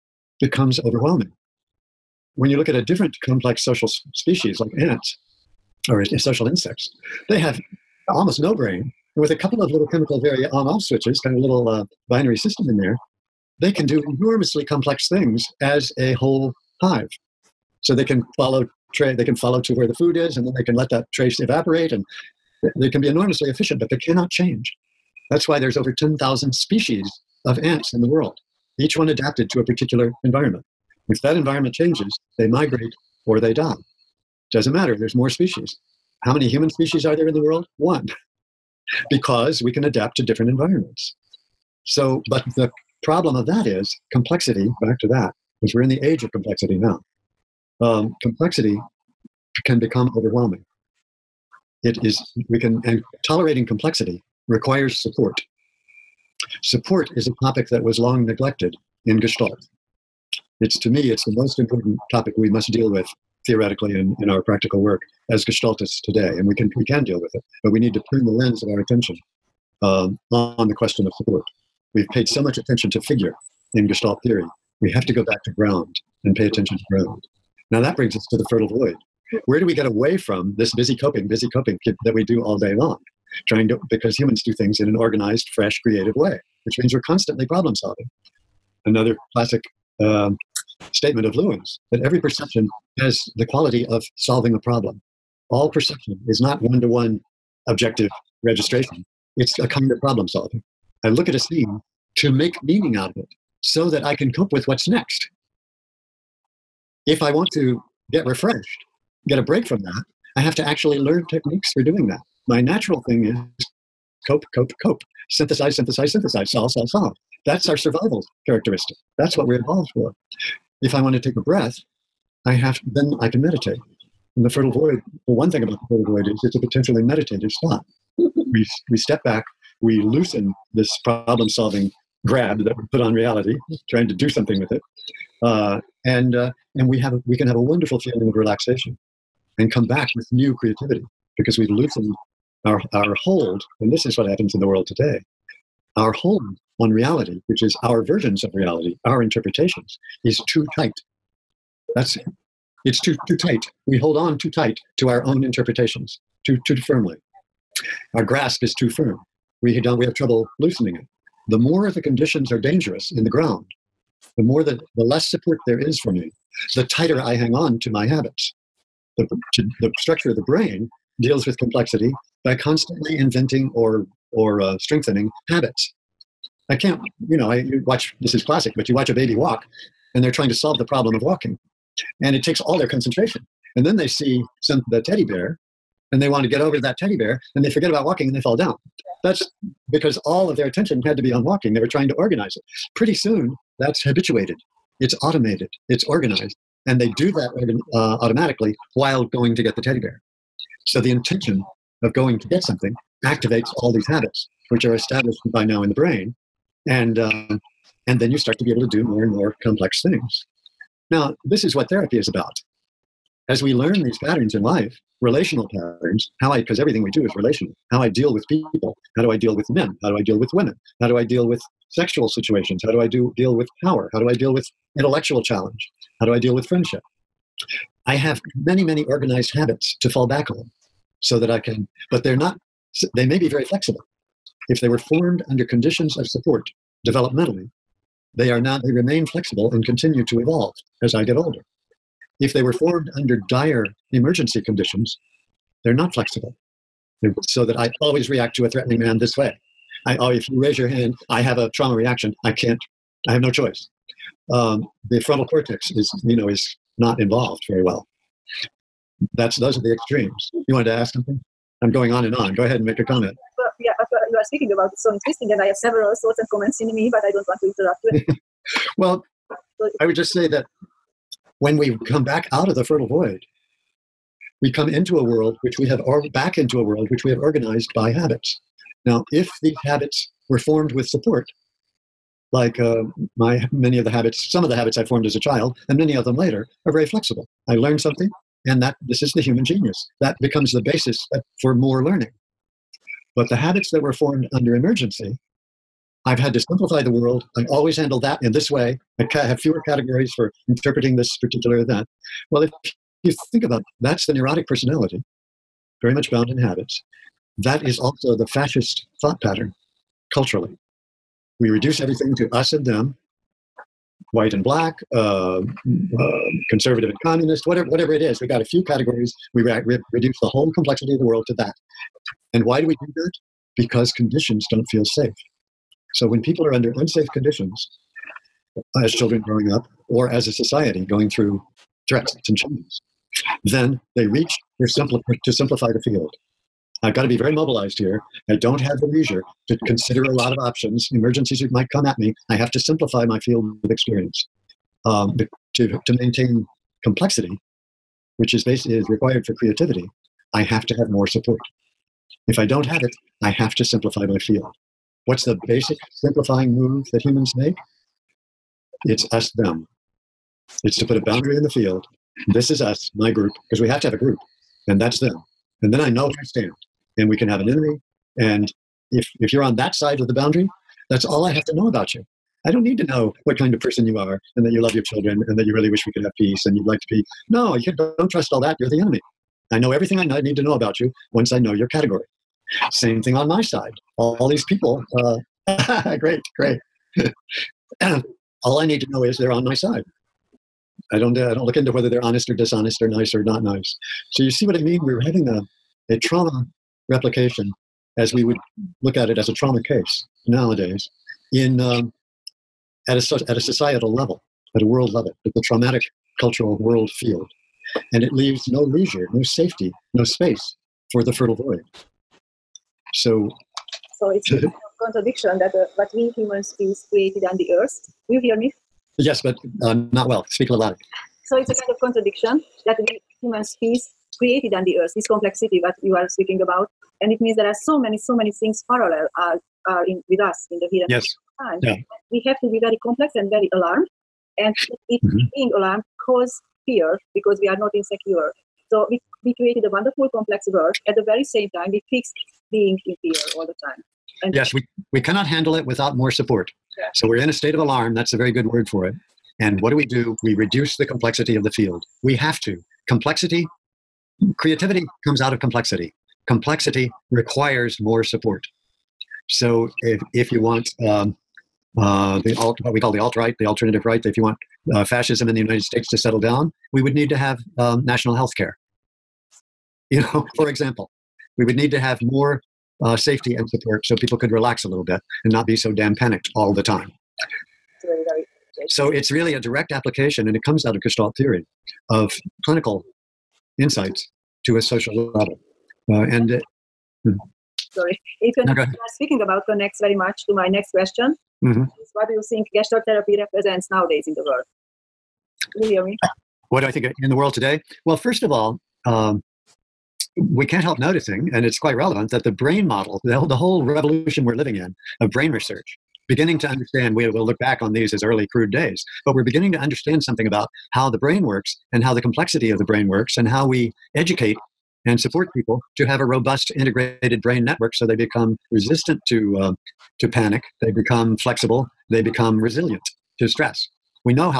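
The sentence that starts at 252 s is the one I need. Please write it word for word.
I can't, I have no choice.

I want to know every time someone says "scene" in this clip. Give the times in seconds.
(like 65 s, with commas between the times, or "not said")
101 s.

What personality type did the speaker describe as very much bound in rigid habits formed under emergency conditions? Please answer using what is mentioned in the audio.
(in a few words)
neurotic personality.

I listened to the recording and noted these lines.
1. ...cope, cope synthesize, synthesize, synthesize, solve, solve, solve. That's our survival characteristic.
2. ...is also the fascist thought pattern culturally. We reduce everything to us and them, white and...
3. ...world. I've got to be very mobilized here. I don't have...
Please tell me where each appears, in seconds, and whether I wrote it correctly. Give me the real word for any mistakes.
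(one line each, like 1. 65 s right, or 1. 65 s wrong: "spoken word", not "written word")
1. 114 s right
2. 307 s right
3. 336 s wrong: "field", not "world".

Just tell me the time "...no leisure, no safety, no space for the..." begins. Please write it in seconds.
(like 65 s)
408 s.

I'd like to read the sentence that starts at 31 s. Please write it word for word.
If that environment changes, they migrate or they die.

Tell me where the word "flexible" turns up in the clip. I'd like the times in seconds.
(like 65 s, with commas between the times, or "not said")
233 s, 239 s, 246 s, 287 s, 521 s.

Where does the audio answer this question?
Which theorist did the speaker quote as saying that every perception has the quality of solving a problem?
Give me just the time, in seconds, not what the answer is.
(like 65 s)
91 s.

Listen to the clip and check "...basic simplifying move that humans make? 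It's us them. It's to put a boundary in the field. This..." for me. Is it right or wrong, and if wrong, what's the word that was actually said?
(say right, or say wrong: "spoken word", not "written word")
right.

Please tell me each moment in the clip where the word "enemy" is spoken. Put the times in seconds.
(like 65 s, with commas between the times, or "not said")
367 s, 379 s.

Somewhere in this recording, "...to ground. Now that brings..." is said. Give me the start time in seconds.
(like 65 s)
76 s.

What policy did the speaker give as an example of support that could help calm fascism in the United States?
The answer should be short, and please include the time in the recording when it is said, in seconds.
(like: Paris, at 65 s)
national health care, at 468 s.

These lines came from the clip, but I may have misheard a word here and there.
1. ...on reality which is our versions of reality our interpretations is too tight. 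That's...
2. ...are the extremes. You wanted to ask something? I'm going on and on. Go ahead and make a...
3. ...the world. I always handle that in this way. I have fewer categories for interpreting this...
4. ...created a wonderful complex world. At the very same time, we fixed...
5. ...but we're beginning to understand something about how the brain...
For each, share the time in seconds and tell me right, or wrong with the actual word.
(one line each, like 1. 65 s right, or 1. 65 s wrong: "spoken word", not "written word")
1. 146 s right
2. 259 s right
3. 297 s right
4. 439 s right
5. 509 s right.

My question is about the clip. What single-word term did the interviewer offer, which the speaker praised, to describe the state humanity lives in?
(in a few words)
alarm.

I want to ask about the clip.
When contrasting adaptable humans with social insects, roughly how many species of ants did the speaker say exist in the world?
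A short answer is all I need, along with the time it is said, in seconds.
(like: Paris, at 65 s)
over 10,000, at 25 s.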